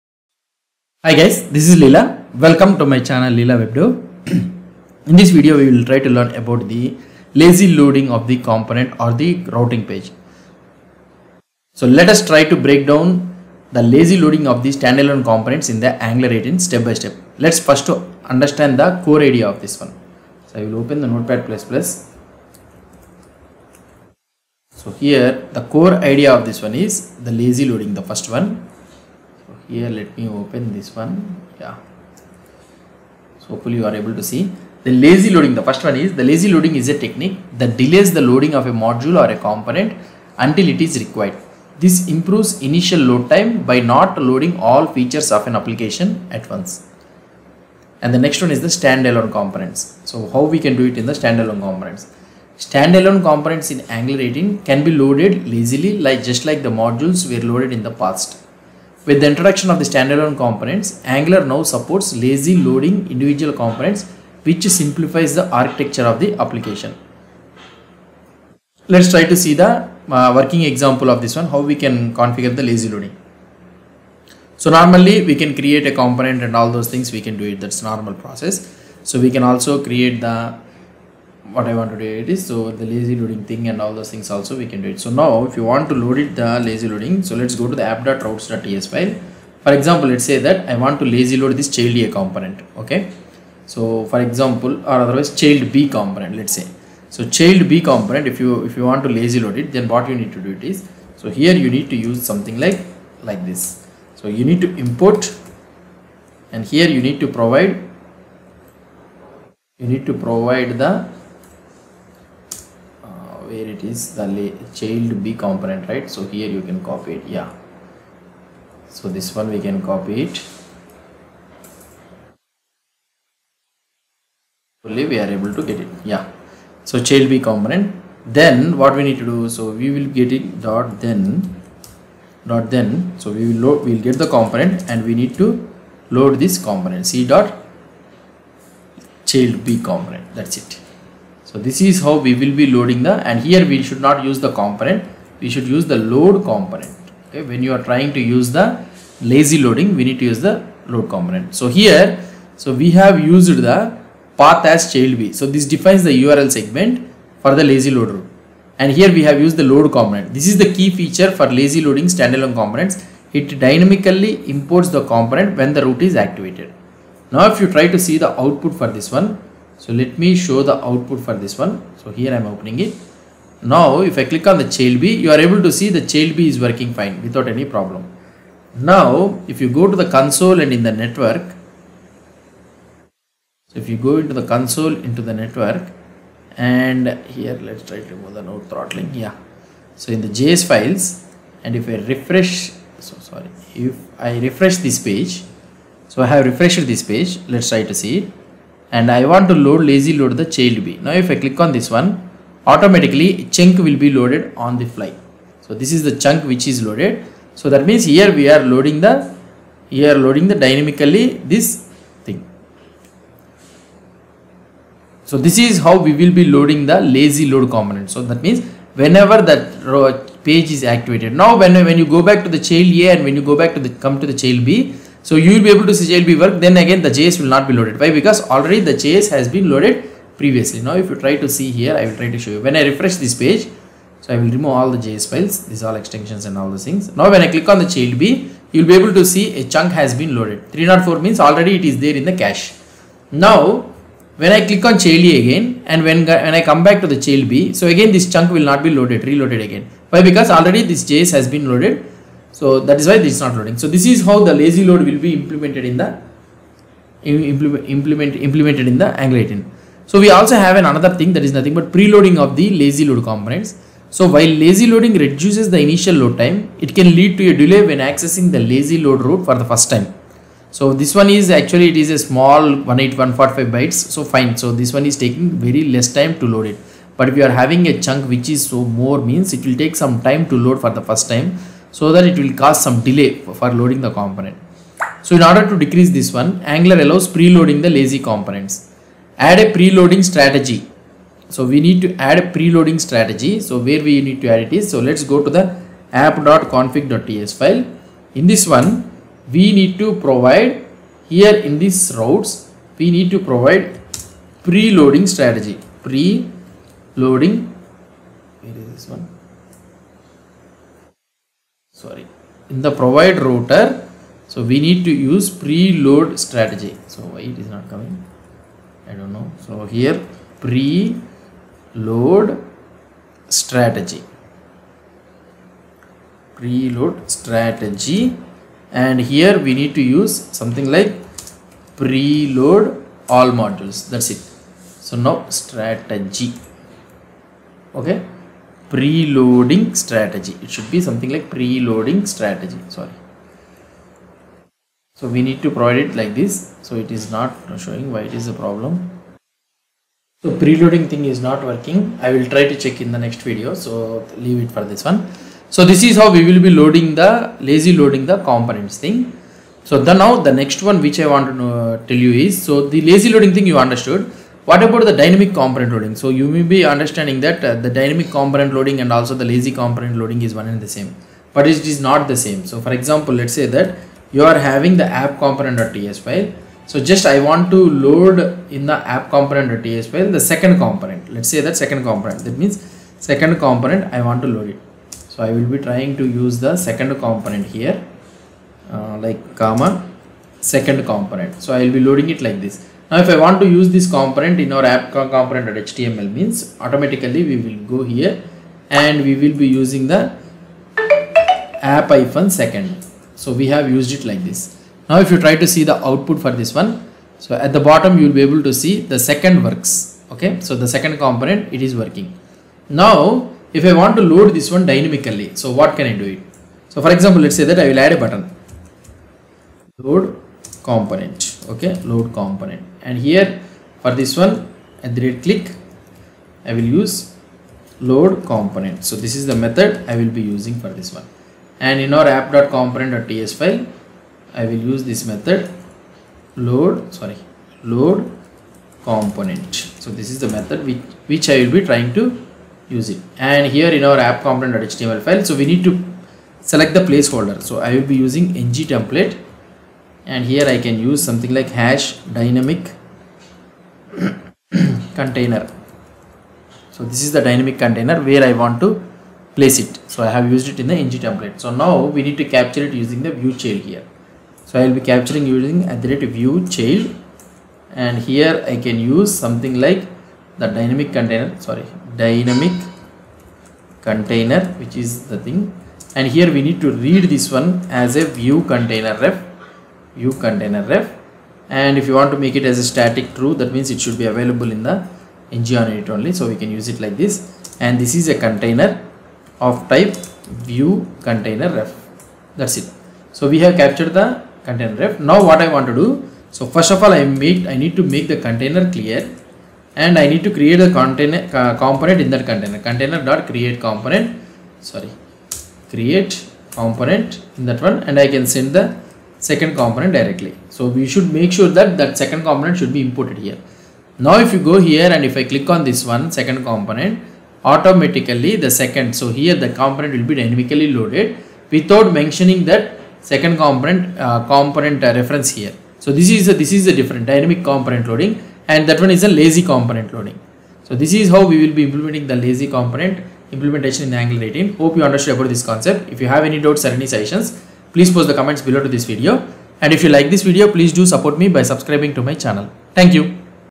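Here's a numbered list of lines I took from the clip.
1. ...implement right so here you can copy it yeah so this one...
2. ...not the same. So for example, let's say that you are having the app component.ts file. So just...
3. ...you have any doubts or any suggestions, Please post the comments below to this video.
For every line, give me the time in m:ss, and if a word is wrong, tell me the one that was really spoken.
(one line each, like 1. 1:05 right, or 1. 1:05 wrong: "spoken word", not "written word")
1. 1:55 wrong: "component", not "implement"
2. 6:11 right
3. 8:56 right.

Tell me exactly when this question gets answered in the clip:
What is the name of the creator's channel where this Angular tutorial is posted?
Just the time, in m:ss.
0:03.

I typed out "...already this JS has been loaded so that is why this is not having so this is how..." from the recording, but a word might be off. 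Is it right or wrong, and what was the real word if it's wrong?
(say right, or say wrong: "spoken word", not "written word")
wrong: "loading", not "having".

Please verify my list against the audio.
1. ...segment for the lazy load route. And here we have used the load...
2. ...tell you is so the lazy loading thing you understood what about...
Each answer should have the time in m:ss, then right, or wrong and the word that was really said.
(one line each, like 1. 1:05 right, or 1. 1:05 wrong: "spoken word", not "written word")
1. 2:36 right
2. 6:02 right.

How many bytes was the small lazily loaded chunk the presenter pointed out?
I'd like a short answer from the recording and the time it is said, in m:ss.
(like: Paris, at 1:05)
18145 bytes, at 4:32.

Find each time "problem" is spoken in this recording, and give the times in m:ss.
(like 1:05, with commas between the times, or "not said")
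2:57, 5:48.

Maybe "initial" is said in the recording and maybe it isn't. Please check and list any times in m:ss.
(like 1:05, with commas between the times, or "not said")
0:42, 4:25.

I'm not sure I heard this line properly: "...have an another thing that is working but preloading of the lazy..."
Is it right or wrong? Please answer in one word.
wrong.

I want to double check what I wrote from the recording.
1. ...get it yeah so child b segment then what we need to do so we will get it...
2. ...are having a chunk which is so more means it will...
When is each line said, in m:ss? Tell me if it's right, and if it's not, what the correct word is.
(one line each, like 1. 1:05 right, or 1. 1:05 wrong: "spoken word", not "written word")
1. 2:05 wrong: "component", not "segment"
2. 4:37 right.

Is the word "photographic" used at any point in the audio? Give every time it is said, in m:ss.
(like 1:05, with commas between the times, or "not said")
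not said.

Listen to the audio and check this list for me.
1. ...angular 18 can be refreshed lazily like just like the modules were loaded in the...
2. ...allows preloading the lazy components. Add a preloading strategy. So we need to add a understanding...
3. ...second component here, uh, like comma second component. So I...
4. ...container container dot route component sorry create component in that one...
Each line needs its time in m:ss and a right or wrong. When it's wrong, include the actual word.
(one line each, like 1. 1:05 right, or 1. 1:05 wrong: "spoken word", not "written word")
1. 0:54 wrong: "loaded", not "refreshed"
2. 4:47 wrong: "preloading", not "understanding"
3. 6:26 right
4. 8:22 wrong: "create", not "route".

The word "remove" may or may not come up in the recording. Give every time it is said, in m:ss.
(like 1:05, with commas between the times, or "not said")
3:08, 3:54.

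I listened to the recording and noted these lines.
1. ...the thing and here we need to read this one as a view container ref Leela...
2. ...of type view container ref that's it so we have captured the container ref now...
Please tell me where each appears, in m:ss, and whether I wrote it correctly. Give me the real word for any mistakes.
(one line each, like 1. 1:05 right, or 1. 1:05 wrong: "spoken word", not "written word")
1. 7:55 wrong: "View", not "Leela"
2. 8:09 right.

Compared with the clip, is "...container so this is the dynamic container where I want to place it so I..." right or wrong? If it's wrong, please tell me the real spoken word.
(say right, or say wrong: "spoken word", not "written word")
right.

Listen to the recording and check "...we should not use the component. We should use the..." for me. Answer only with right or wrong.
right.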